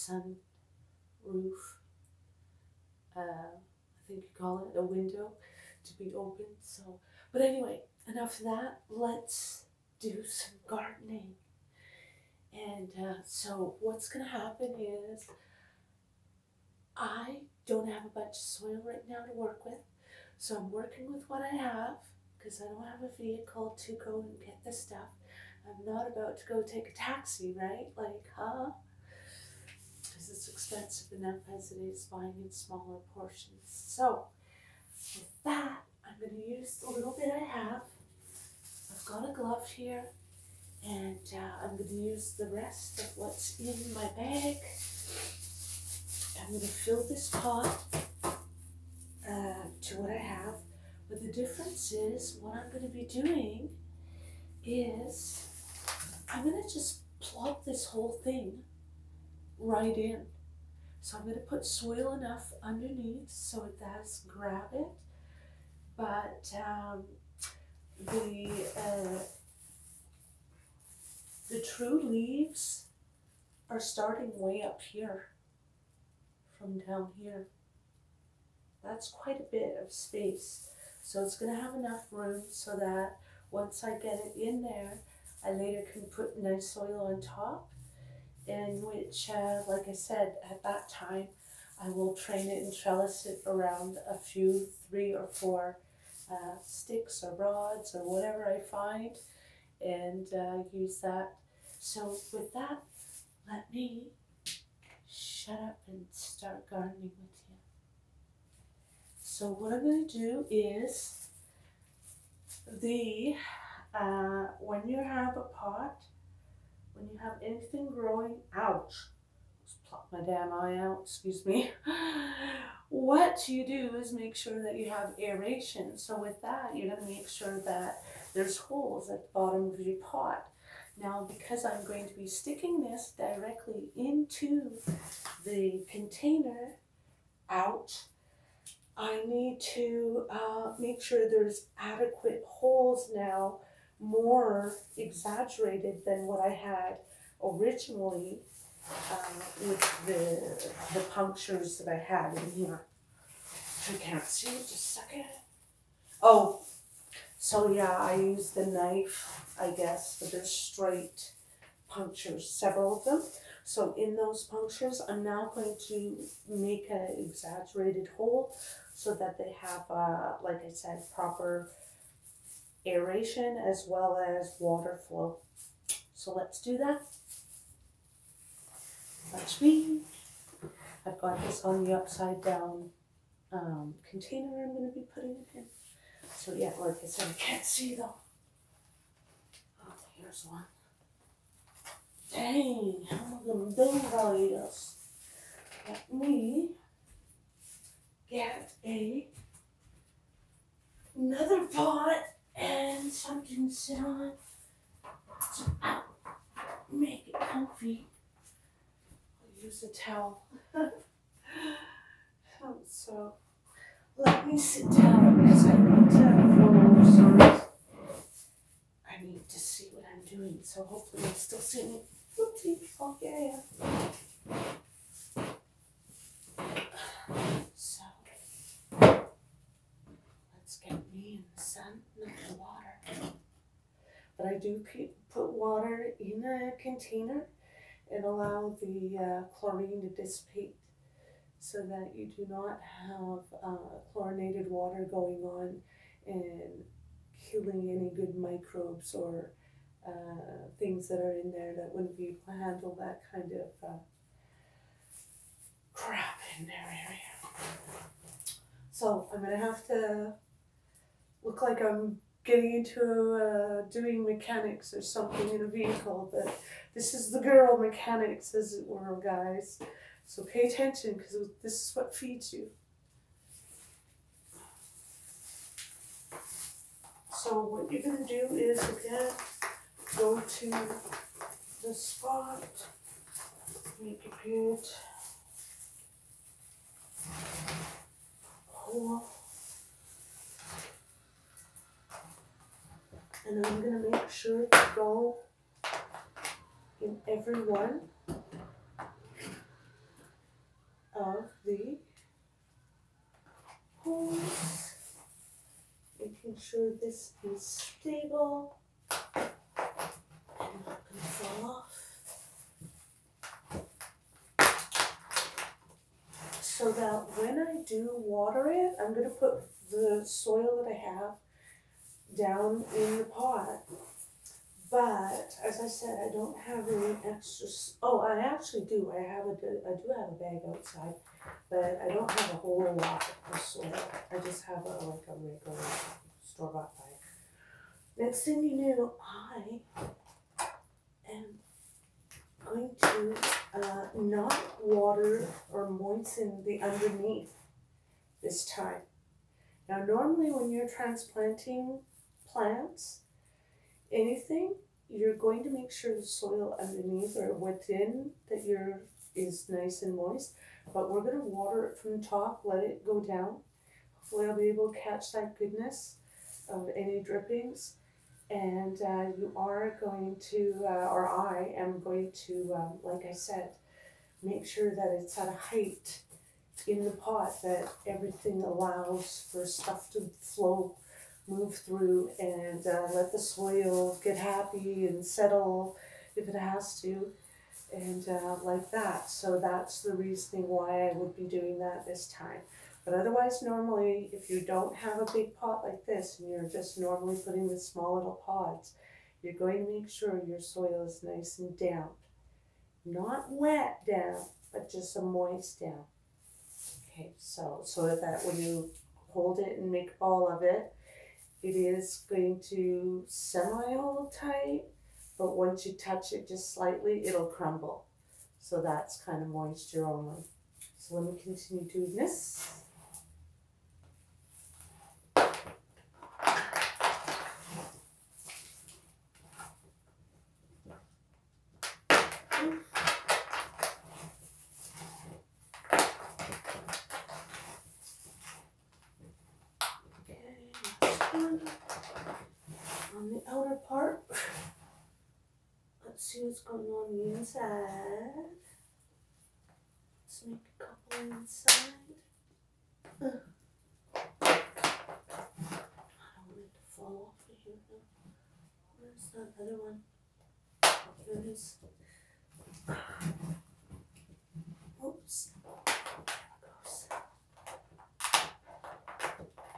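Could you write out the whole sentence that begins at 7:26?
see what's going on the inside.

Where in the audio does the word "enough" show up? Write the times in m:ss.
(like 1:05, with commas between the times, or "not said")
0:08, 0:31, 1:02, 1:21.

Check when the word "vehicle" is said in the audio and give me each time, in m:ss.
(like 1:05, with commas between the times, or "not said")
0:23, 4:25.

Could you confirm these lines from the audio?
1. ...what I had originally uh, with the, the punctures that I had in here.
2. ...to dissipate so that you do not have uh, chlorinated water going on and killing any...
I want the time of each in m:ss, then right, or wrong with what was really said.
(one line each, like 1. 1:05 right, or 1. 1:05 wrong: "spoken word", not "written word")
1. 2:26 right
2. 4:00 right.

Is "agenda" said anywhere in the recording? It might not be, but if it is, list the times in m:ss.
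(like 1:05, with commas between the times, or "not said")
not said.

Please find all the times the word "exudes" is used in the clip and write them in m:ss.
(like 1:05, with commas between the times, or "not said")
not said.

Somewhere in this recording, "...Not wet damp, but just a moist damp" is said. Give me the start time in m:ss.
6:43.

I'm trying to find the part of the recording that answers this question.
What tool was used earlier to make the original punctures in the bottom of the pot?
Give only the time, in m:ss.
2:38.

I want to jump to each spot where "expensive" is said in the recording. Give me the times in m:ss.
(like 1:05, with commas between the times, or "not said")
0:30.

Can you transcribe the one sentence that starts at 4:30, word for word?
So pay attention because this is what feeds you.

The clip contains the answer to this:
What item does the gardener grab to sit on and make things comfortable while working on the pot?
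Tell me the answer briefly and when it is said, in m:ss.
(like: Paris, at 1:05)
Towel, at 3:29.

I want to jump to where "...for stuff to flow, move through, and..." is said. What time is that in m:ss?
6:19.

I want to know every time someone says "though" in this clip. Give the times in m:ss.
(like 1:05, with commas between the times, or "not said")
3:07.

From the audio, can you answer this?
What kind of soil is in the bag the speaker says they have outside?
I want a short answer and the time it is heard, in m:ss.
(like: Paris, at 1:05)
Regular store bought, at 5:35.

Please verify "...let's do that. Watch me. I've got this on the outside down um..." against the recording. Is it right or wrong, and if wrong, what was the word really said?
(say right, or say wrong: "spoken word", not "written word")
wrong: "upside", not "outside".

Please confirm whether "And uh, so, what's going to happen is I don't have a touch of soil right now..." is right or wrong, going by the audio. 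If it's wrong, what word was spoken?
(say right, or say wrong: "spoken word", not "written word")
wrong: "bunch", not "touch".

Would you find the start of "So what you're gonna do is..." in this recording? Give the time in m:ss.
4:37.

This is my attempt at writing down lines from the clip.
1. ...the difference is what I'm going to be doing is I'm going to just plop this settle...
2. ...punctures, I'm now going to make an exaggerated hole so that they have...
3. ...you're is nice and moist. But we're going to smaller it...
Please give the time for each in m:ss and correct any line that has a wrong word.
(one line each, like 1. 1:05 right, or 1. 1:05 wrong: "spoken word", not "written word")
1. 0:51 wrong: "whole", not "settle"
2. 2:44 right
3. 5:58 wrong: "water", not "smaller".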